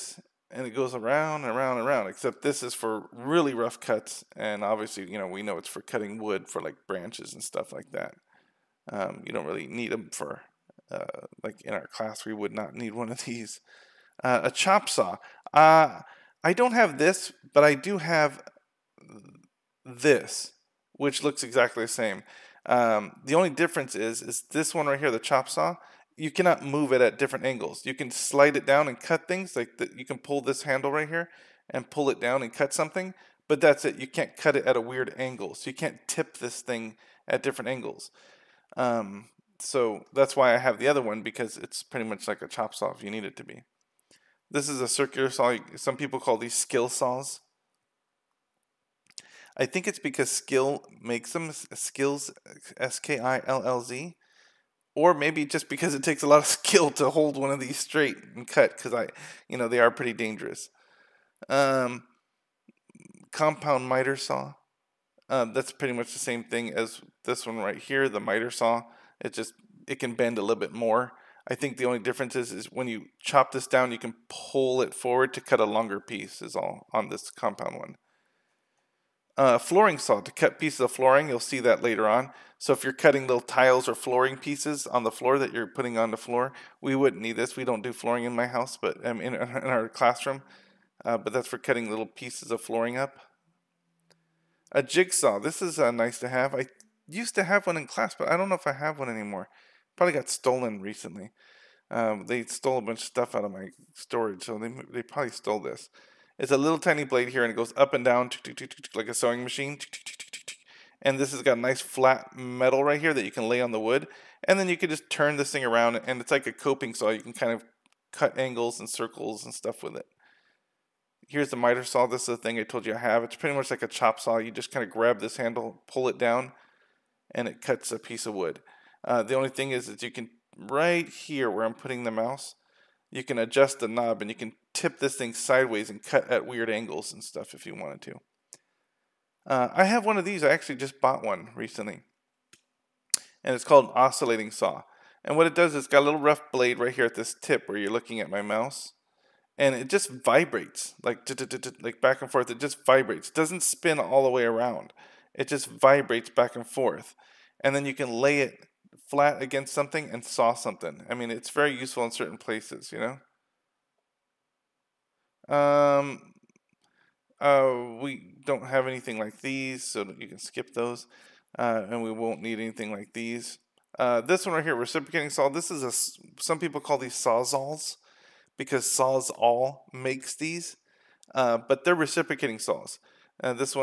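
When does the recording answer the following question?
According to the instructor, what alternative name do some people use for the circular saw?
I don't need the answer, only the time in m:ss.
0:46.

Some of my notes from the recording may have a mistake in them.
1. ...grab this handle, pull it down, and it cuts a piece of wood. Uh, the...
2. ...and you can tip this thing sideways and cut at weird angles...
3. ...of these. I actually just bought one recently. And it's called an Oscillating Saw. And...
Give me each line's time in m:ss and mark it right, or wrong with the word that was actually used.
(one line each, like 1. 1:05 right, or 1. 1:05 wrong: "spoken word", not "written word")
1. 2:04 right
2. 2:14 right
3. 2:20 right.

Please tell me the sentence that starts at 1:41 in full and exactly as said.
Um, they stole a bunch of stuff out of my storage, so they they probably stole this.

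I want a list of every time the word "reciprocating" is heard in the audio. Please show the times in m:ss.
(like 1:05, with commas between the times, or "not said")
2:54, 3:01.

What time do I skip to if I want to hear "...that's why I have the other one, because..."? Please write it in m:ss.
0:40.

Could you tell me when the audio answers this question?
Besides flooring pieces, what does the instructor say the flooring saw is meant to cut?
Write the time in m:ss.
1:23.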